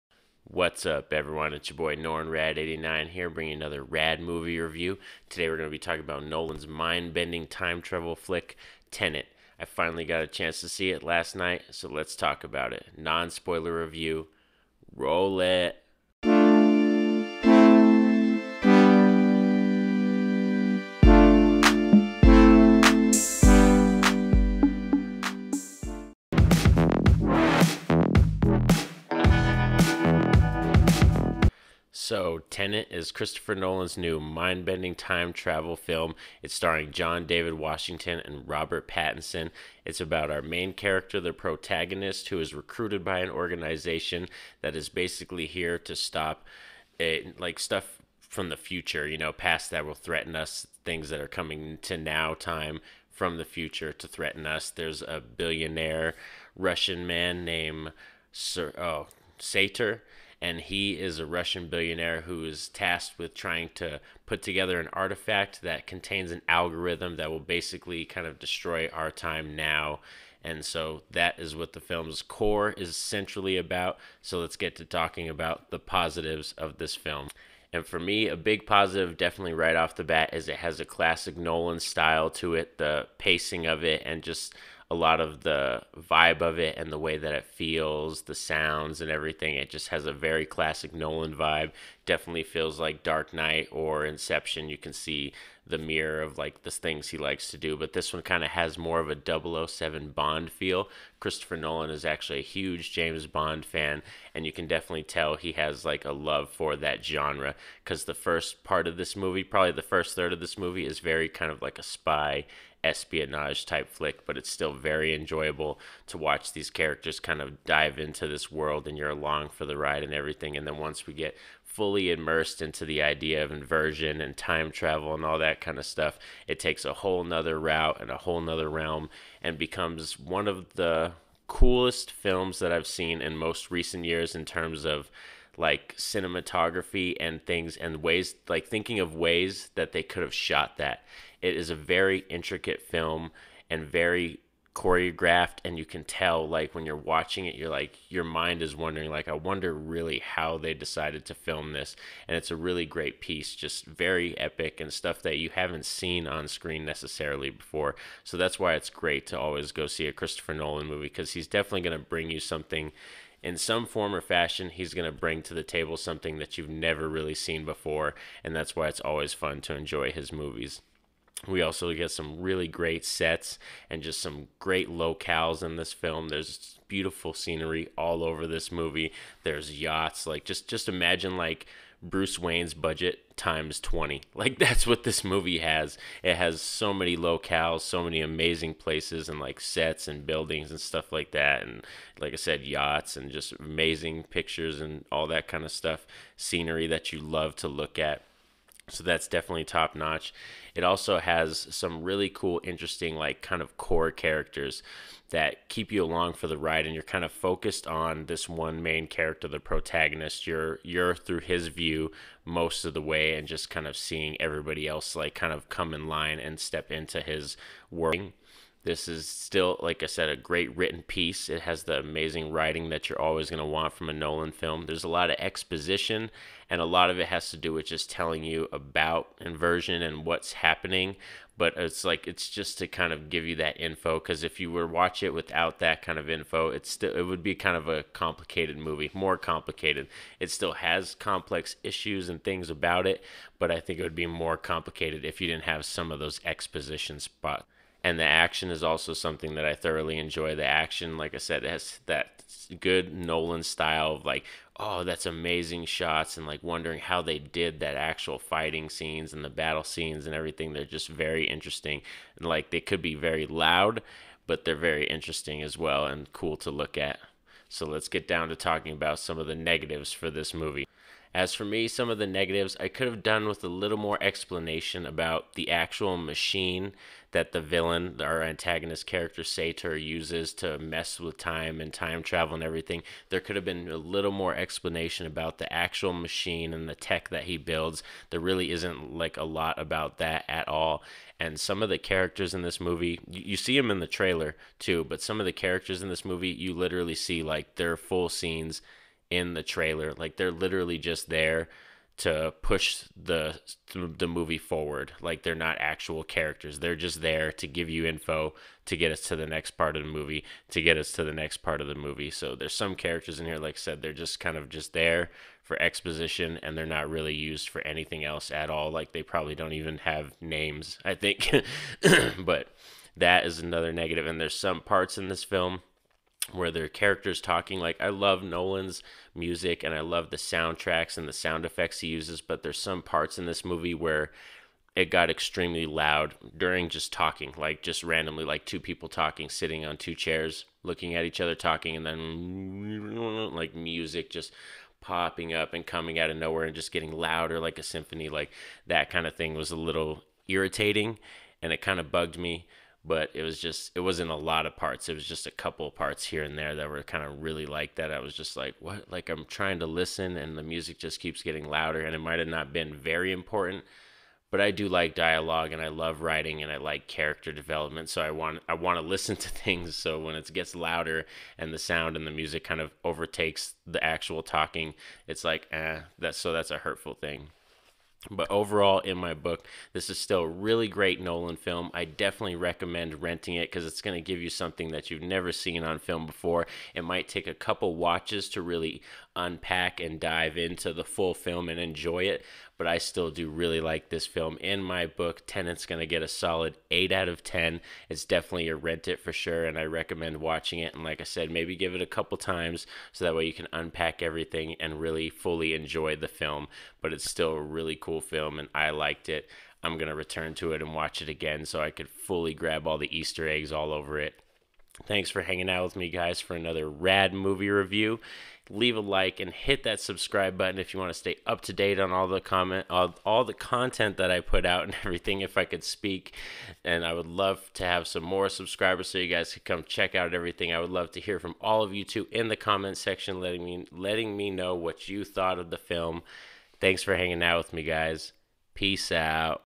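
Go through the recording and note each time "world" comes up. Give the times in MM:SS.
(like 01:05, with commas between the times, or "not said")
01:58, 03:37.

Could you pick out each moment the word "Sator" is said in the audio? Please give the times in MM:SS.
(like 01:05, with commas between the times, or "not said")
00:59, 04:39.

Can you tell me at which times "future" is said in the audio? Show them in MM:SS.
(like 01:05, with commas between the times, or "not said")
00:48, 00:53.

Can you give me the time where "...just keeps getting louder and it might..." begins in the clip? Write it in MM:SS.
06:00.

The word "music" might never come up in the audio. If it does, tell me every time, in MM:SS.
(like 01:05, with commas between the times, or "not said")
05:29, 05:43, 06:00, 06:12.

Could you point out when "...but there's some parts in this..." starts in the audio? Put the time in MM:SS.
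05:32.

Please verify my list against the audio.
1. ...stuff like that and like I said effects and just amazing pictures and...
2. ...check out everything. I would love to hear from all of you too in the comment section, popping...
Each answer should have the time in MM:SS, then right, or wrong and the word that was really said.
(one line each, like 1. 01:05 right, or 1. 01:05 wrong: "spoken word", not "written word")
1. 03:10 wrong: "yachts", not "effects"
2. 07:09 wrong: "letting", not "popping".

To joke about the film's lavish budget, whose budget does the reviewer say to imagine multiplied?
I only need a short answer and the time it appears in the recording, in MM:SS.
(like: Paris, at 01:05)
Bruce Wayne's, at 03:02.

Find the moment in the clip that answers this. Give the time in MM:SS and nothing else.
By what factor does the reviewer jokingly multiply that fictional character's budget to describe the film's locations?
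03:03.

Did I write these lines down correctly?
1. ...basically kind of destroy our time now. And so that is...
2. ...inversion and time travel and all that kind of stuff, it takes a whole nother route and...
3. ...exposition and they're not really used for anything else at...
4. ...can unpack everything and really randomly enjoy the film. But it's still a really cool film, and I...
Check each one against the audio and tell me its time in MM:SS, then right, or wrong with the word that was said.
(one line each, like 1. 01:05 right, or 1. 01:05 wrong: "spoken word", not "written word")
1. 01:07 right
2. 02:03 right
3. 05:15 right
4. 06:43 wrong: "fully", not "randomly".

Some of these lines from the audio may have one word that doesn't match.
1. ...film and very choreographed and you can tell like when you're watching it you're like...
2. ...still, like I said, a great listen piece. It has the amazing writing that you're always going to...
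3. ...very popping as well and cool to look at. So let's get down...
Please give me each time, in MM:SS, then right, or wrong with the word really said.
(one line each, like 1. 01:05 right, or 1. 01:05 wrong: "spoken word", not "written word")
1. 02:22 right
2. 03:39 wrong: "written", not "listen"
3. 04:24 wrong: "interesting", not "popping".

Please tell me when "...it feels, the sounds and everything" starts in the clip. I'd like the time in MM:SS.
01:27.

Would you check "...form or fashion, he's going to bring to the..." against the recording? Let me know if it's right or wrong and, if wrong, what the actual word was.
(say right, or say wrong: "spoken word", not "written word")
right.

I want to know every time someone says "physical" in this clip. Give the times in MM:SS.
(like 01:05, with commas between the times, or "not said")
not said.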